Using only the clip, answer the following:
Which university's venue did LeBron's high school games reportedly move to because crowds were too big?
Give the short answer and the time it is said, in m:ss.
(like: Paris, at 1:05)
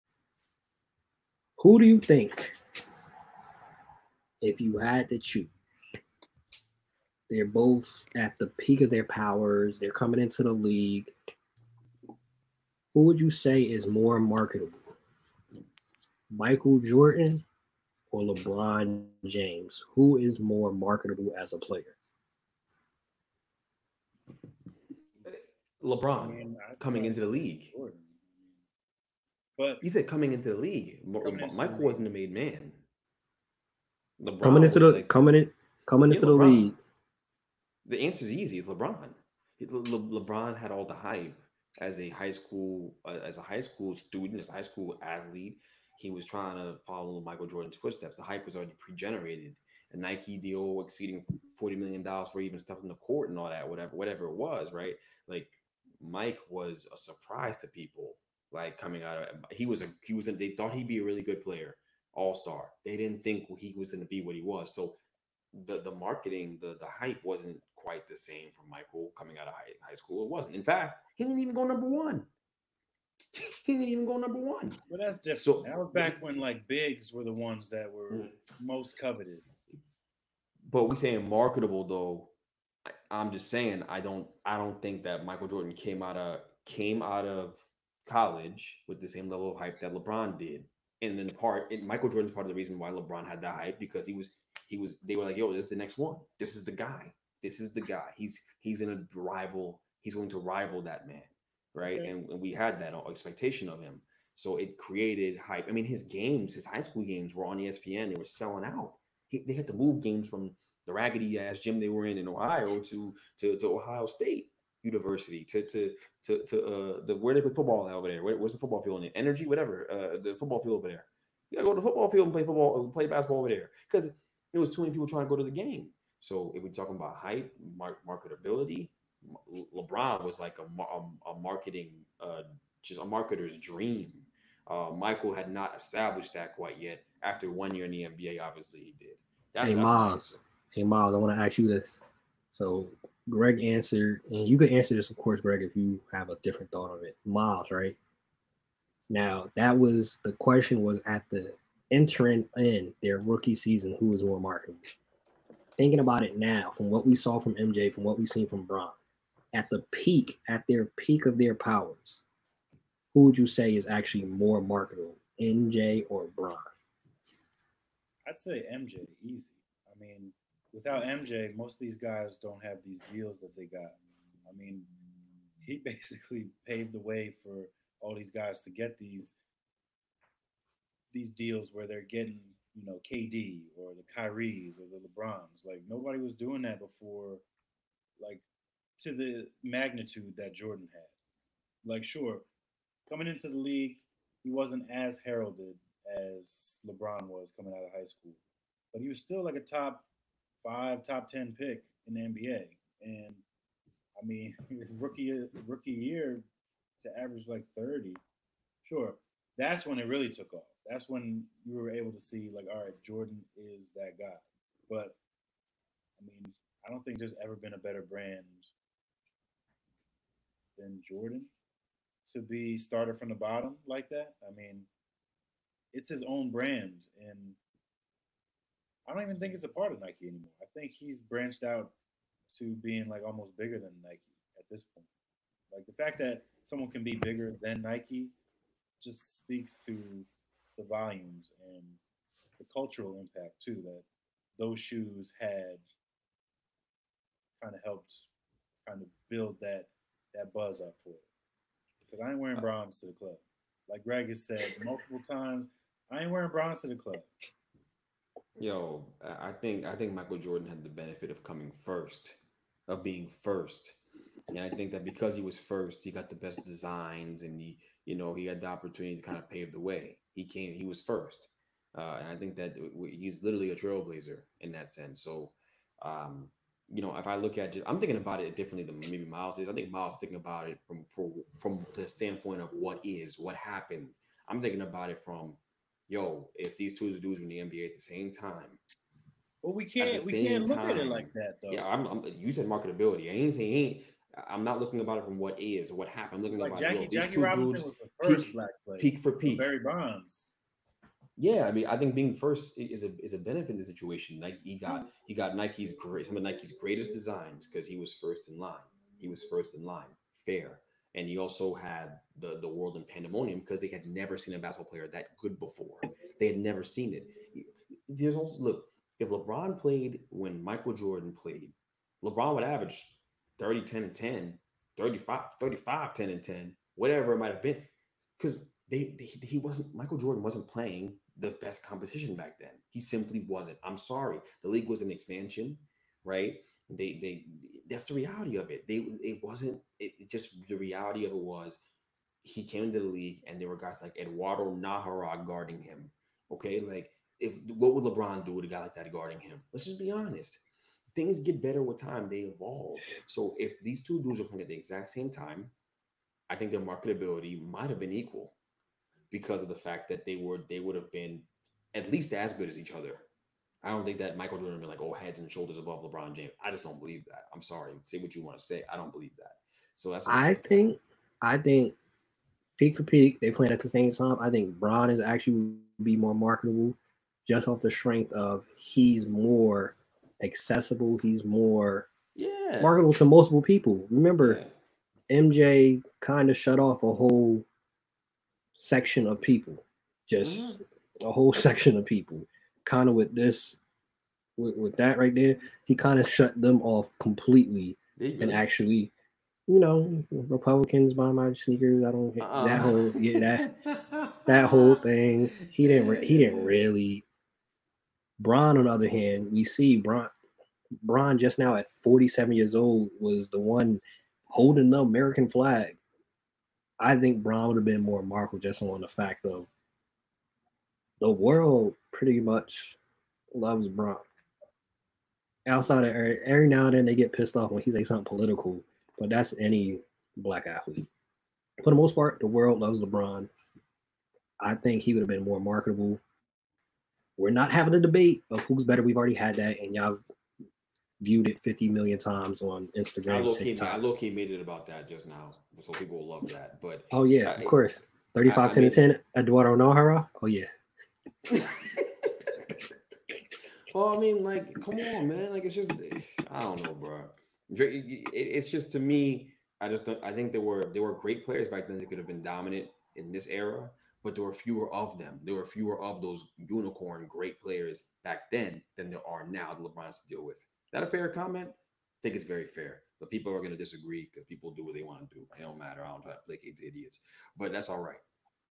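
Ohio State University, at 1:53.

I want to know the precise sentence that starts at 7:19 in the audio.
We've already had that, and y'all viewed it 50 million times on Instagram.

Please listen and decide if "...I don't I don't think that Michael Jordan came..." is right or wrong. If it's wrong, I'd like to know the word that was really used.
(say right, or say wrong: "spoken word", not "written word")
right.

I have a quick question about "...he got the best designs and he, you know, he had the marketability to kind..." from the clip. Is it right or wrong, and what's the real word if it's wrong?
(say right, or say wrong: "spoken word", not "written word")
wrong: "opportunity", not "marketability".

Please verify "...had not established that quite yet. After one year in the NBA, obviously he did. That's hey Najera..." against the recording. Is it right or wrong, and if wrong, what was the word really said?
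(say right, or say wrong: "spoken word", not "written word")
wrong: "Miles", not "Najera".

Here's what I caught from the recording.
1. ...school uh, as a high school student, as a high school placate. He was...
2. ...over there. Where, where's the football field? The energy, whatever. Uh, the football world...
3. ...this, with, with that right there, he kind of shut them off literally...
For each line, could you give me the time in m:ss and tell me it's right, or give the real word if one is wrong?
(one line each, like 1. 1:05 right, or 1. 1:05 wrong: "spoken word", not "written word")
1. 0:42 wrong: "athlete", not "placate"
2. 1:57 wrong: "field", not "world"
3. 6:33 wrong: "completely", not "literally".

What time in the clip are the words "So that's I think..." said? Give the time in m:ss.
6:09.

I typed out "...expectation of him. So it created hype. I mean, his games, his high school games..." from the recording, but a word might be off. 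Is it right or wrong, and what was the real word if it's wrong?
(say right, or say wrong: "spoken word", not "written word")
right.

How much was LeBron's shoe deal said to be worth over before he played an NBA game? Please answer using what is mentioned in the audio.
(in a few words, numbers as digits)
$40 million.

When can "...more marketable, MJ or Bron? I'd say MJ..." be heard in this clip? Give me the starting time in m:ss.
2:44.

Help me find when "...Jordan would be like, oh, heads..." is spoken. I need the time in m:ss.
6:04.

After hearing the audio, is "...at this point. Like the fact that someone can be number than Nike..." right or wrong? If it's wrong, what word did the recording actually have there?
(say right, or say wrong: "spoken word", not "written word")
wrong: "bigger", not "number".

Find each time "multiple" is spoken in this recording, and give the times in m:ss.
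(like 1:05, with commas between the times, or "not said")
4:14, 6:23.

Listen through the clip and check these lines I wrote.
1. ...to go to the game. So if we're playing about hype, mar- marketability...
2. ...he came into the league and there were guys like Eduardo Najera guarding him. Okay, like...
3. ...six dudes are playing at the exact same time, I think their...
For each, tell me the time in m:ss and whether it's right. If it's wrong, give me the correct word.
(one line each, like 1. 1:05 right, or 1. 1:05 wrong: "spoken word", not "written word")
1. 2:05 wrong: "talking", not "playing"
2. 5:42 right
3. 5:54 wrong: "two", not "six".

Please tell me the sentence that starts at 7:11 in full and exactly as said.
For the most part, the world loves LeBron.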